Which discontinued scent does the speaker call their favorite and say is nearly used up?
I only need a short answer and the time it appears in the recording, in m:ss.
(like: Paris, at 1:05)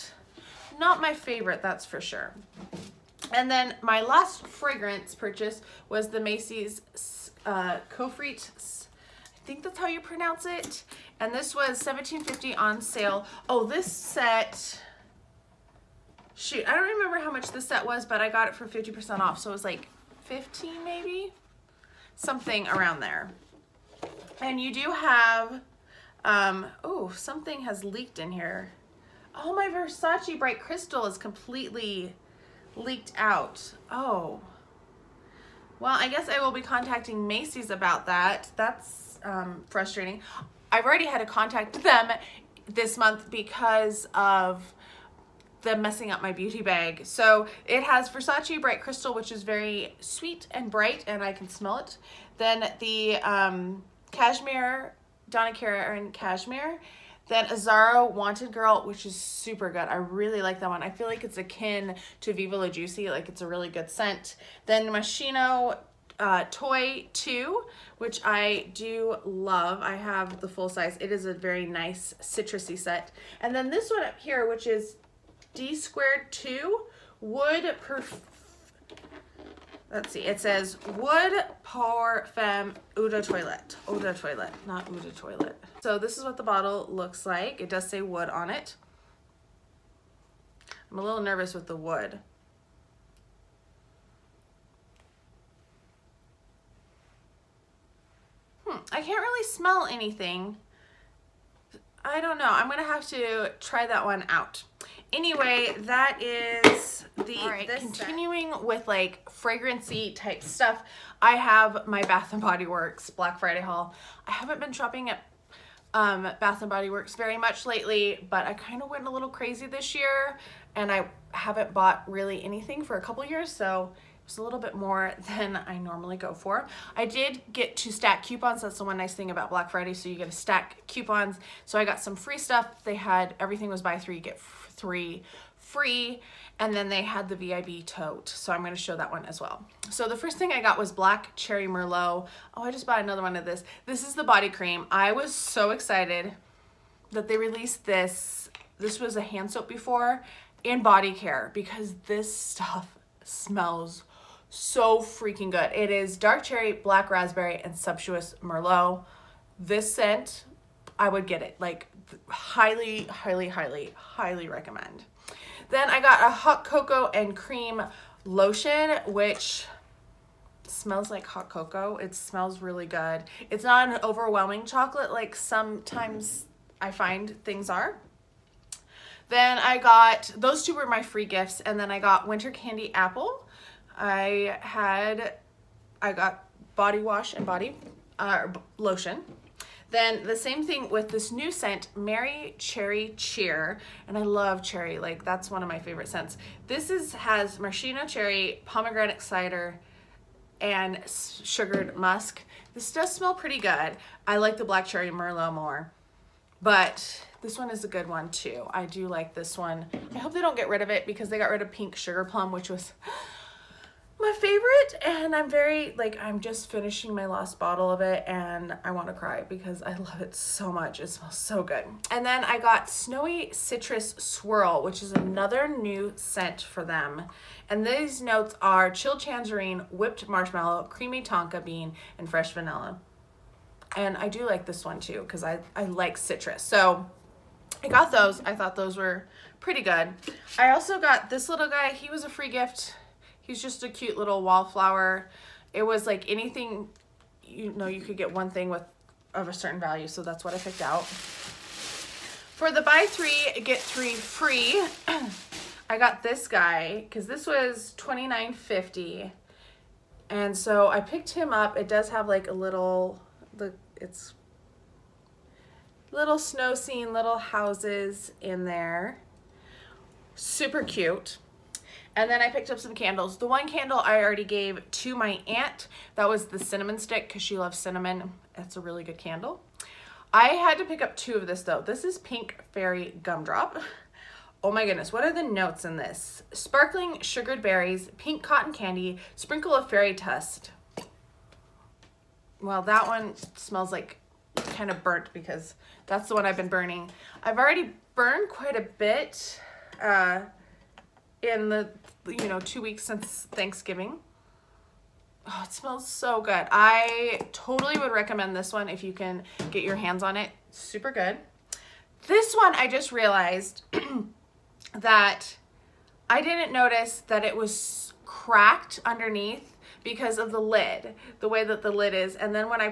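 Pink Sugar Plum, at 3:31.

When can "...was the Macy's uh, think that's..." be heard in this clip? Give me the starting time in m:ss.
0:05.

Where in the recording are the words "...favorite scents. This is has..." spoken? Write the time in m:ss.
3:15.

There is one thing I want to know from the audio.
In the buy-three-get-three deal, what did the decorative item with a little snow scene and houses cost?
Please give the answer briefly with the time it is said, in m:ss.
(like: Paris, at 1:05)
$29.50, at 4:17.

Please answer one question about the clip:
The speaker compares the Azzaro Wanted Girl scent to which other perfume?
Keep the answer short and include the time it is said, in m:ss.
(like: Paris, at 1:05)
Viva La Juicy, at 1:02.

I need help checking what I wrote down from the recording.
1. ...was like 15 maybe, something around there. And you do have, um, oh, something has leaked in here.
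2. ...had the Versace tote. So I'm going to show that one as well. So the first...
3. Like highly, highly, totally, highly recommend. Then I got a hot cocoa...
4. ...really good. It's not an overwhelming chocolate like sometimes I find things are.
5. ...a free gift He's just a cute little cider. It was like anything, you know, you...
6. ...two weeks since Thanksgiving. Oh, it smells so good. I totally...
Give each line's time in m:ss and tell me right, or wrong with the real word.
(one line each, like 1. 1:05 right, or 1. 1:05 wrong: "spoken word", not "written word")
1. 0:19 right
2. 2:17 wrong: "VIB", not "Versace"
3. 2:41 wrong: "highly", not "totally"
4. 2:52 right
5. 4:02 wrong: "wallflower", not "cider"
6. 5:02 right.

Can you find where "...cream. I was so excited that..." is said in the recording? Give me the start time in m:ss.
2:24.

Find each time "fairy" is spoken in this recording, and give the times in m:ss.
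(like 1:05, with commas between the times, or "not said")
4:42, 4:49.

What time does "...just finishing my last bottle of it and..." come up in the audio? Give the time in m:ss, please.
3:36.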